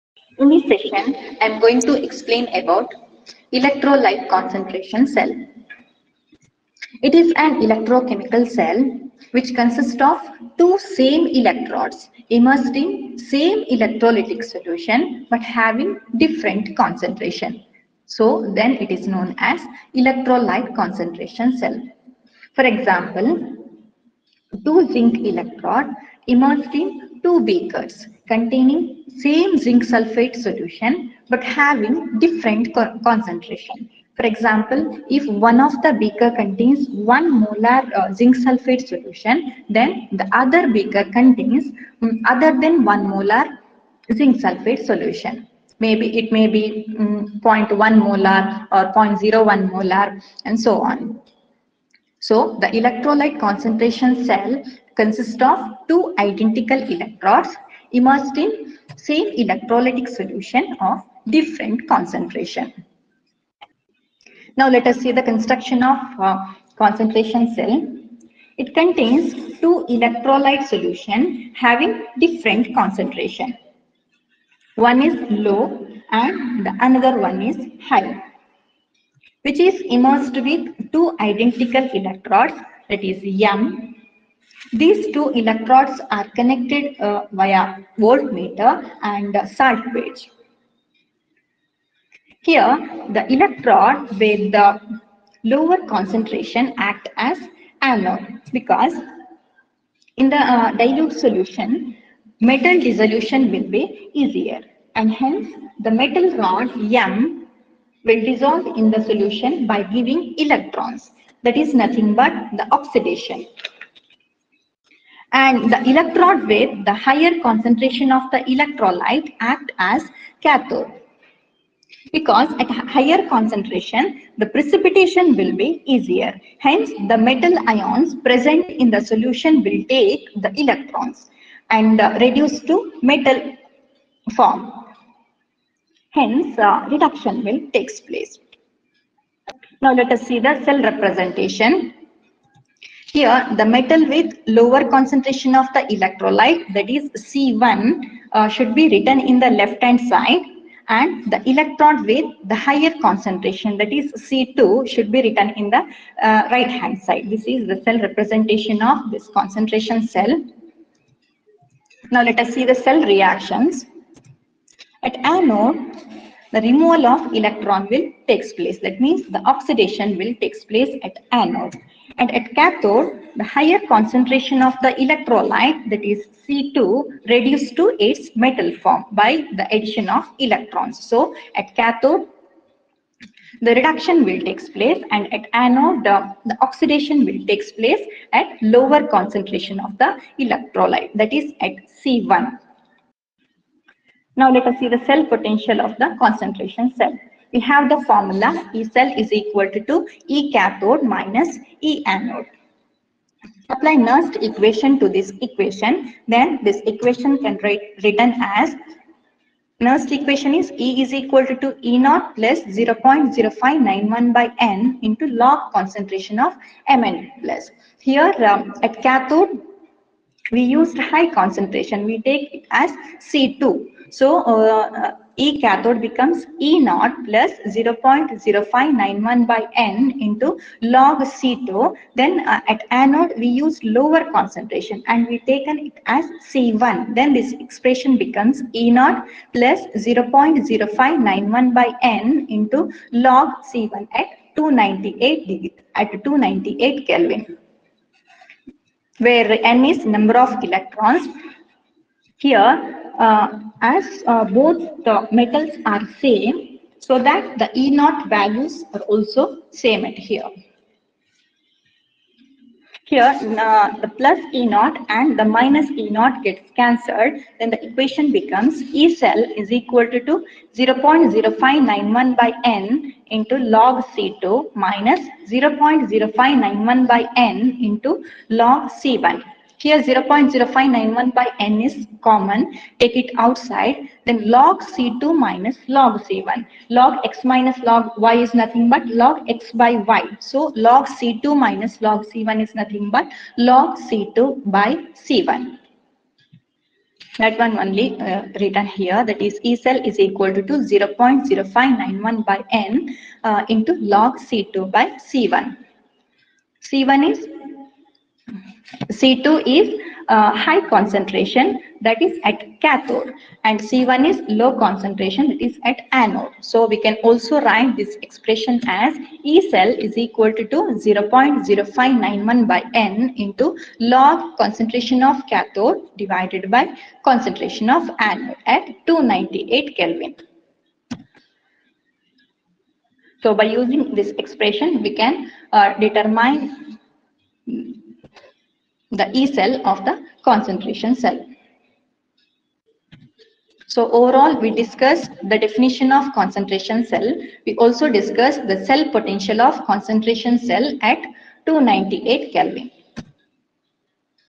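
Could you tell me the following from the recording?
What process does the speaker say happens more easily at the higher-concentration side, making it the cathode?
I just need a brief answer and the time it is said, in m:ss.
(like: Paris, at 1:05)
precipitation, at 2:04.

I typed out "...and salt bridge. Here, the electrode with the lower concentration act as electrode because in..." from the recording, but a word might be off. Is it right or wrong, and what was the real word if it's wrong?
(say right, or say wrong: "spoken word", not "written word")
wrong: "anode", not "electrode".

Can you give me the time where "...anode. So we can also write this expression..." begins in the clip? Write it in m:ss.
5:16.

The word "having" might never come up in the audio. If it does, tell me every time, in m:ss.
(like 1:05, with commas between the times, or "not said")
0:15, 0:31, 1:11.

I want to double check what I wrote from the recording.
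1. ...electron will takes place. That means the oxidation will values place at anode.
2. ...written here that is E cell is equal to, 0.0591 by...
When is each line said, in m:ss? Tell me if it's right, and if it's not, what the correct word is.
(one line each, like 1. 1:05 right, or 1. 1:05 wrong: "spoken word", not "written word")
1. 2:47 wrong: "takes", not "values"
2. 4:58 right.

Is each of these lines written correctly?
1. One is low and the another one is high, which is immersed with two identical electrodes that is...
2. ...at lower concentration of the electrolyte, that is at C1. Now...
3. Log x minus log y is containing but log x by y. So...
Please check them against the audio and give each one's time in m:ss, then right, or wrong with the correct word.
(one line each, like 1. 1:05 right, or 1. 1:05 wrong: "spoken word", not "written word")
1. 1:14 right
2. 3:08 right
3. 4:46 wrong: "nothing", not "containing".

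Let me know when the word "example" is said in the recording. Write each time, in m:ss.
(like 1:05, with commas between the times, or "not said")
0:22, 0:34.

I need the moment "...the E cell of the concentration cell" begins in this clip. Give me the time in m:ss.
5:39.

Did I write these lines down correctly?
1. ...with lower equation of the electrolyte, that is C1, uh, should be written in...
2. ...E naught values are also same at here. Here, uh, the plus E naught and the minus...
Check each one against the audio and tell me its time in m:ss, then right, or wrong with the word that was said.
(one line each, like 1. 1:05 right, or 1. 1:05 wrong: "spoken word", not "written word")
1. 2:24 wrong: "concentration", not "equation"
2. 4:17 right.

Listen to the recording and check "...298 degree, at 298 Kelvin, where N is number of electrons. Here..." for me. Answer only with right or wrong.
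right.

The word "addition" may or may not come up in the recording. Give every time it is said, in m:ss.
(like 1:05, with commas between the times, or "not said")
2:59.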